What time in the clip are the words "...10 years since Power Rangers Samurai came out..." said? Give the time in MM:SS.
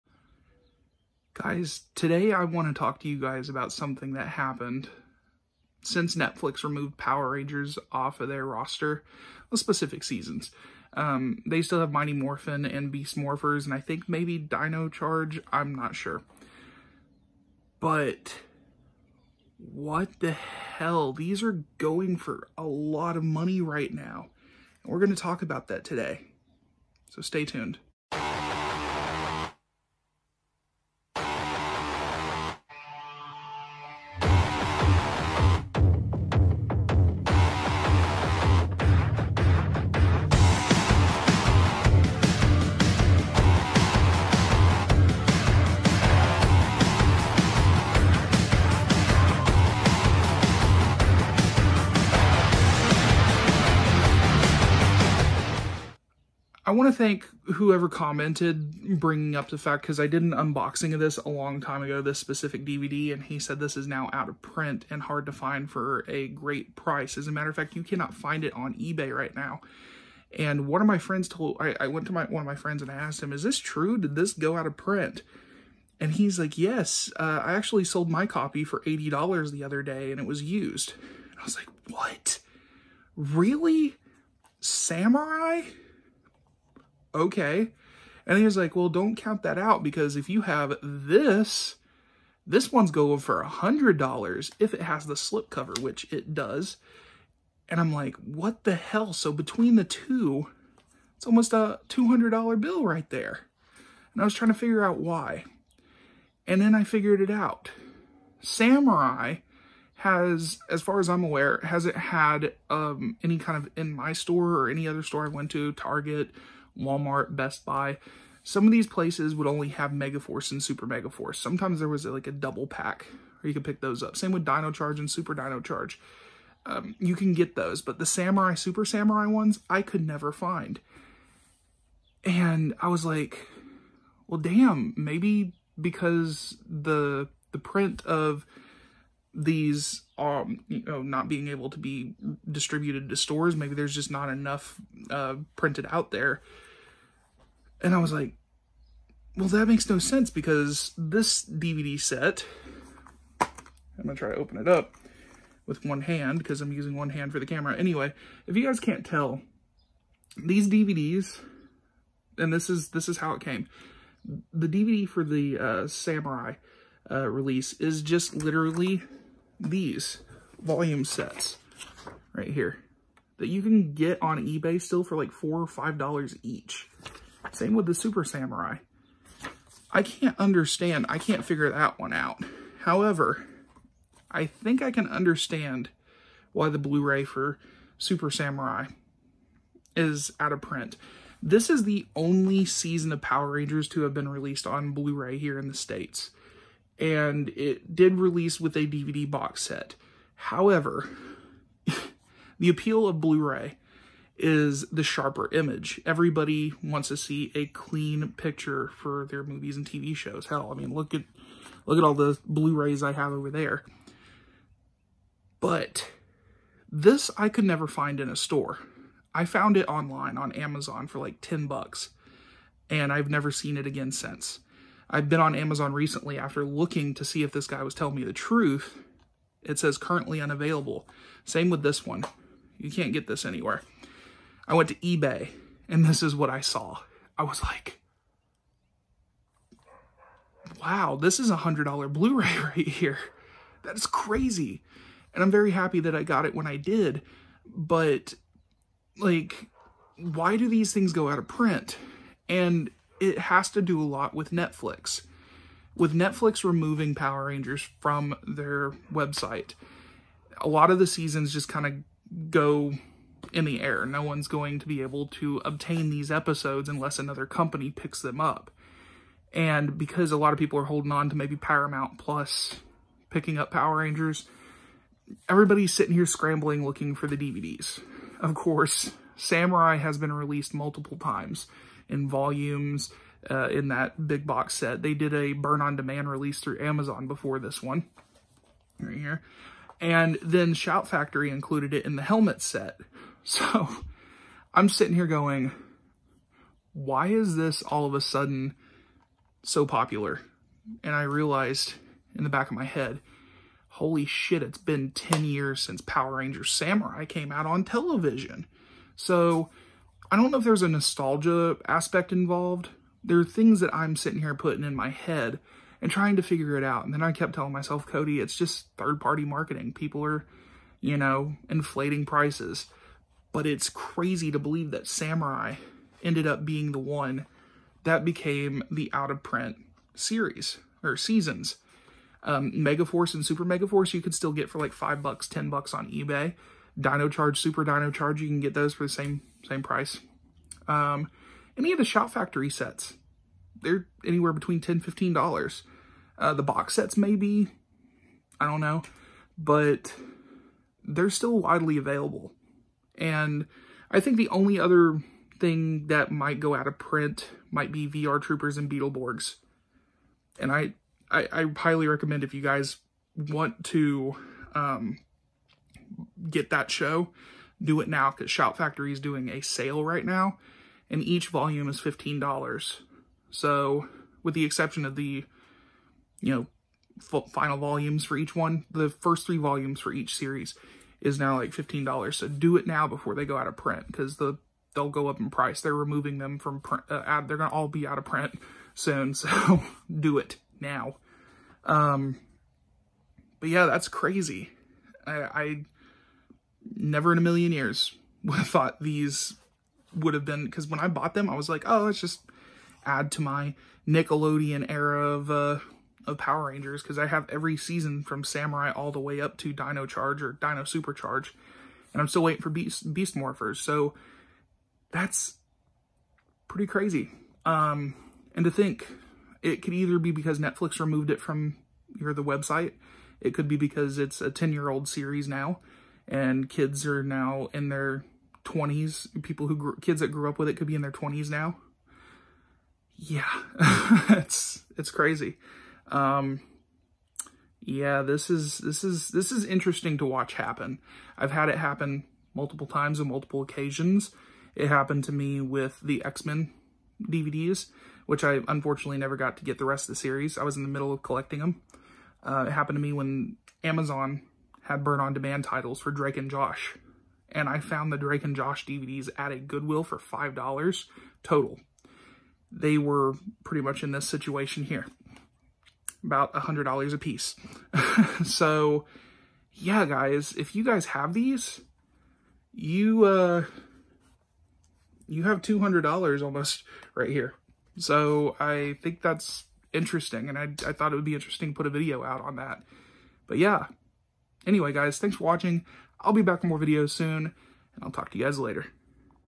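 05:05.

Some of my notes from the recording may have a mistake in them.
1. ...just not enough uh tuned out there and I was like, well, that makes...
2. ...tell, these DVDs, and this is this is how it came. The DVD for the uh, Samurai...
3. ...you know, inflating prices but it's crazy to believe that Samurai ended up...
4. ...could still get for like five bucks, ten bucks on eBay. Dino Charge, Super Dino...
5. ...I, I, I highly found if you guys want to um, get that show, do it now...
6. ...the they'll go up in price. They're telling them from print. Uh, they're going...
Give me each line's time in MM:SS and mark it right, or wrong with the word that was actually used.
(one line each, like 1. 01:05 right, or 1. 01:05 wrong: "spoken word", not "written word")
1. 02:23 wrong: "printed", not "tuned"
2. 02:39 right
3. 05:20 right
4. 05:34 right
5. 06:00 wrong: "recommend", not "found"
6. 06:24 wrong: "removing", not "telling".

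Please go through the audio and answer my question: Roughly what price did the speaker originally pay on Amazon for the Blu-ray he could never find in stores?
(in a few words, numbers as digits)
$10.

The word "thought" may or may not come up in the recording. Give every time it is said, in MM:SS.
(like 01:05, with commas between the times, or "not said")
06:38, 08:00.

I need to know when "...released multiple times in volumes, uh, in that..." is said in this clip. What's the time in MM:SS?
04:40.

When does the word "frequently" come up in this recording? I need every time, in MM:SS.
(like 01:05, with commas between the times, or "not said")
not said.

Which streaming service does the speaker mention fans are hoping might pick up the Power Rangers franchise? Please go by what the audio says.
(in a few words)
Paramount Plus.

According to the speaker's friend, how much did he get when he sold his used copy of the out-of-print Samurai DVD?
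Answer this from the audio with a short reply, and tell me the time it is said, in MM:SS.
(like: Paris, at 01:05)
$80, at 01:18.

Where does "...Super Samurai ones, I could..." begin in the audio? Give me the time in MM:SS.
02:08.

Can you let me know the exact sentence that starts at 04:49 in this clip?
And then Shout Factory included it in the helmet set.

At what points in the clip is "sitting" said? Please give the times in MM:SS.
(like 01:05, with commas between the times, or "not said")
04:35, 04:54, 05:14.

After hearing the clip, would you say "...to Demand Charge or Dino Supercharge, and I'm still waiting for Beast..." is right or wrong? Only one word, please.
wrong.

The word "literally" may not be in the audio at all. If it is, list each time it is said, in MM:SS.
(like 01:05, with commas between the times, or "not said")
02:48.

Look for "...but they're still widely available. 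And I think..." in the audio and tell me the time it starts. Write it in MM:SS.
05:49.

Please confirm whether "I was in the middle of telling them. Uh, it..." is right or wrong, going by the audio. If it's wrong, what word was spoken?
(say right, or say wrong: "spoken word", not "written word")
wrong: "collecting", not "telling".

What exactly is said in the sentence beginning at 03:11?
This is the only season of Power Rangers to have been released on Blu-ray here in the States.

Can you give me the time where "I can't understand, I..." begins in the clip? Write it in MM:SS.
02:59.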